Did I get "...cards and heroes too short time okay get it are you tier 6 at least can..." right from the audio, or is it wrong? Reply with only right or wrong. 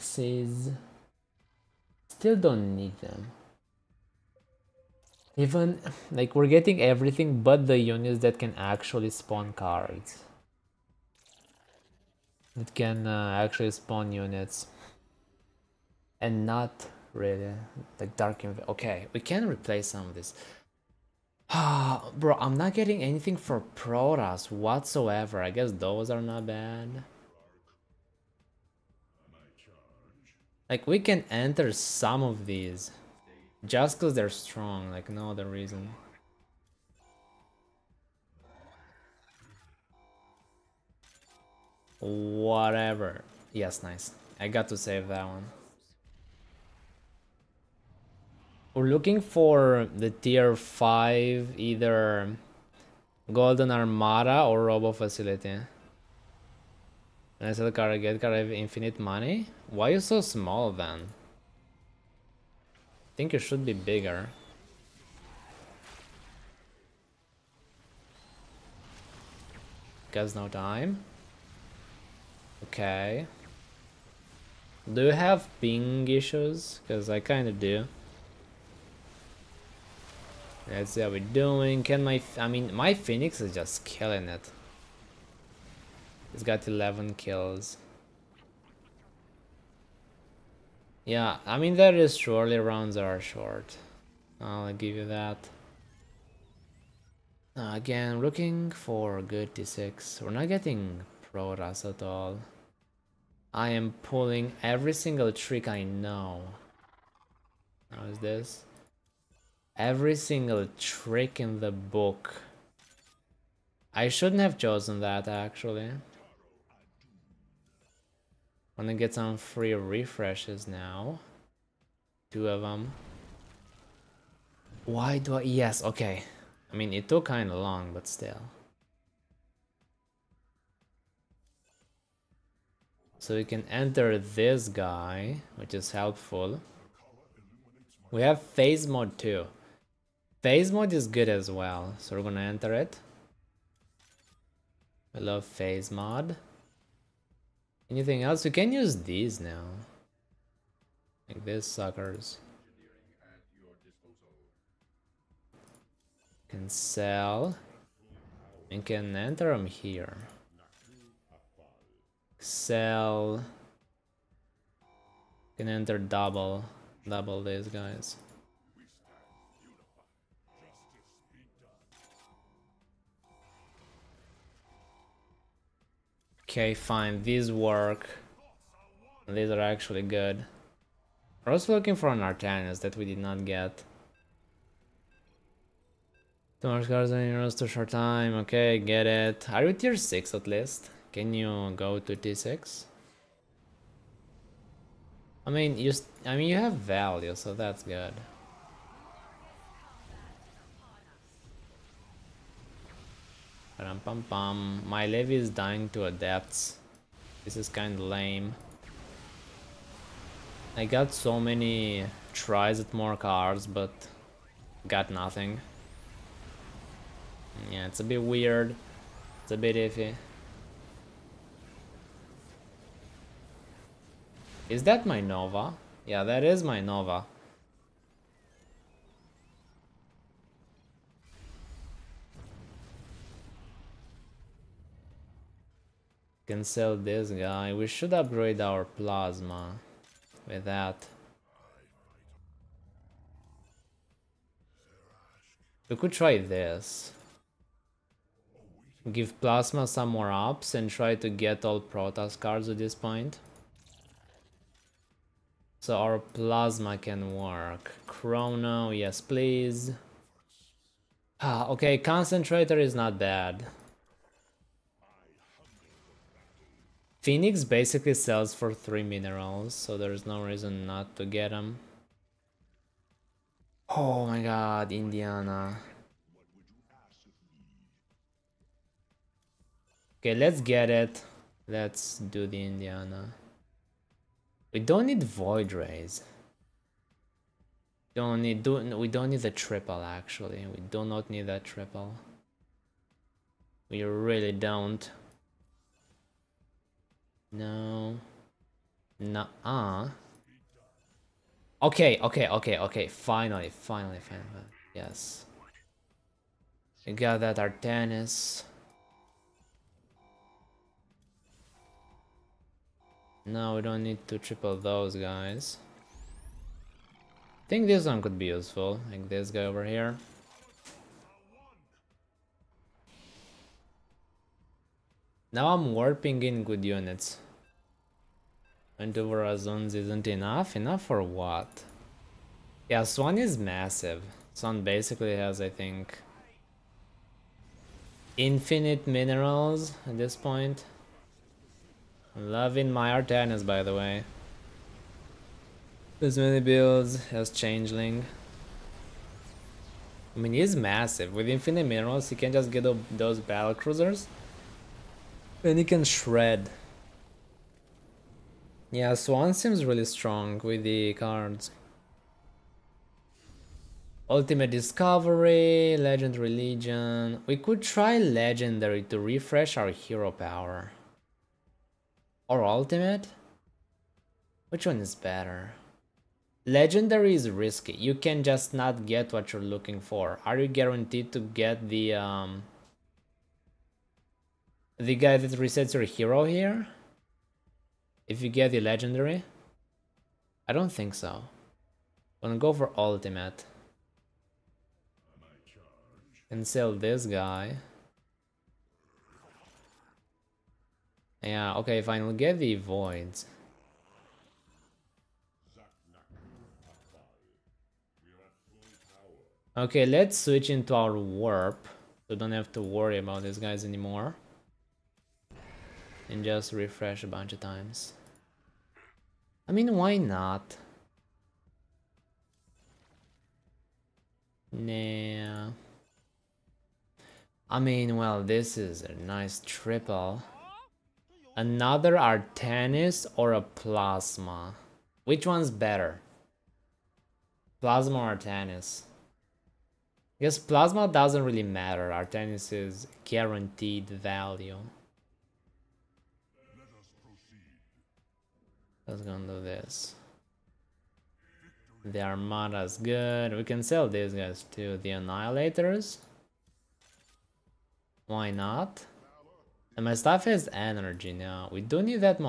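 right.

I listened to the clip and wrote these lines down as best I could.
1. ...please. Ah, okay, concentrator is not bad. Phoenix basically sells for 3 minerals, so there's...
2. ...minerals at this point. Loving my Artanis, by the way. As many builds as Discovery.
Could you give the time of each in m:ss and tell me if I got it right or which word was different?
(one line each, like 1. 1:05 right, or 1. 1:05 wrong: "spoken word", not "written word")
1. 4:19 right
2. 5:39 wrong: "Changeling", not "Discovery".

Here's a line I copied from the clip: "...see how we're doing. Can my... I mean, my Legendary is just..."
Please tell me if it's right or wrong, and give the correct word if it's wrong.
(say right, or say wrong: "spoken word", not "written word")
wrong: "Phoenix", not "Legendary".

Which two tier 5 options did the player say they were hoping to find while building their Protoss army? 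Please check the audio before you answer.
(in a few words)
Golden Armada or Robo Facility.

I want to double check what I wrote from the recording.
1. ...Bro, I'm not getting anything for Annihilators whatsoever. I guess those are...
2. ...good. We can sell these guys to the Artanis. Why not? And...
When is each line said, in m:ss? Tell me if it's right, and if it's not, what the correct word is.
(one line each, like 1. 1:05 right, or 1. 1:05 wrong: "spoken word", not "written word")
1. 0:22 wrong: "Protoss", not "Annihilators"
2. 7:32 wrong: "Annihilators", not "Artanis".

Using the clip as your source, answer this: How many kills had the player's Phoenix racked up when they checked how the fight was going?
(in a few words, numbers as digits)
11.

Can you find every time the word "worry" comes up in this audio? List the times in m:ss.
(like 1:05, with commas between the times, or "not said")
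6:52.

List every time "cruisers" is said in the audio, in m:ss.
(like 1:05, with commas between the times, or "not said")
5:53.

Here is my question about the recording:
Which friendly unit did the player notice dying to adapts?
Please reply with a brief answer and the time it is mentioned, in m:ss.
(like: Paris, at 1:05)
Levy, at 3:25.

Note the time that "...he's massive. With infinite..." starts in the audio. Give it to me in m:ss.
5:50.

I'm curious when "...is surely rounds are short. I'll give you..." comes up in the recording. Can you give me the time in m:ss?
1:31.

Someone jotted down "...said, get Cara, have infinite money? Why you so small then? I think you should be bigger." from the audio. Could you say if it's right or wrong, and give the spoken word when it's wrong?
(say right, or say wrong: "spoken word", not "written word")
right.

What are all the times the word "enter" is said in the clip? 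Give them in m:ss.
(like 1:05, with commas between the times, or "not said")
0:31, 2:13, 2:22, 2:39, 2:45.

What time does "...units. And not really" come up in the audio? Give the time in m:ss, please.
0:14.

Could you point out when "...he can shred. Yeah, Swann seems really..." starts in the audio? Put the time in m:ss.
5:55.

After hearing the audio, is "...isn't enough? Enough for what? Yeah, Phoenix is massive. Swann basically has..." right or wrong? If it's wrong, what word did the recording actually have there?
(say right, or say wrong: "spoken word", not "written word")
wrong: "Swann", not "Phoenix".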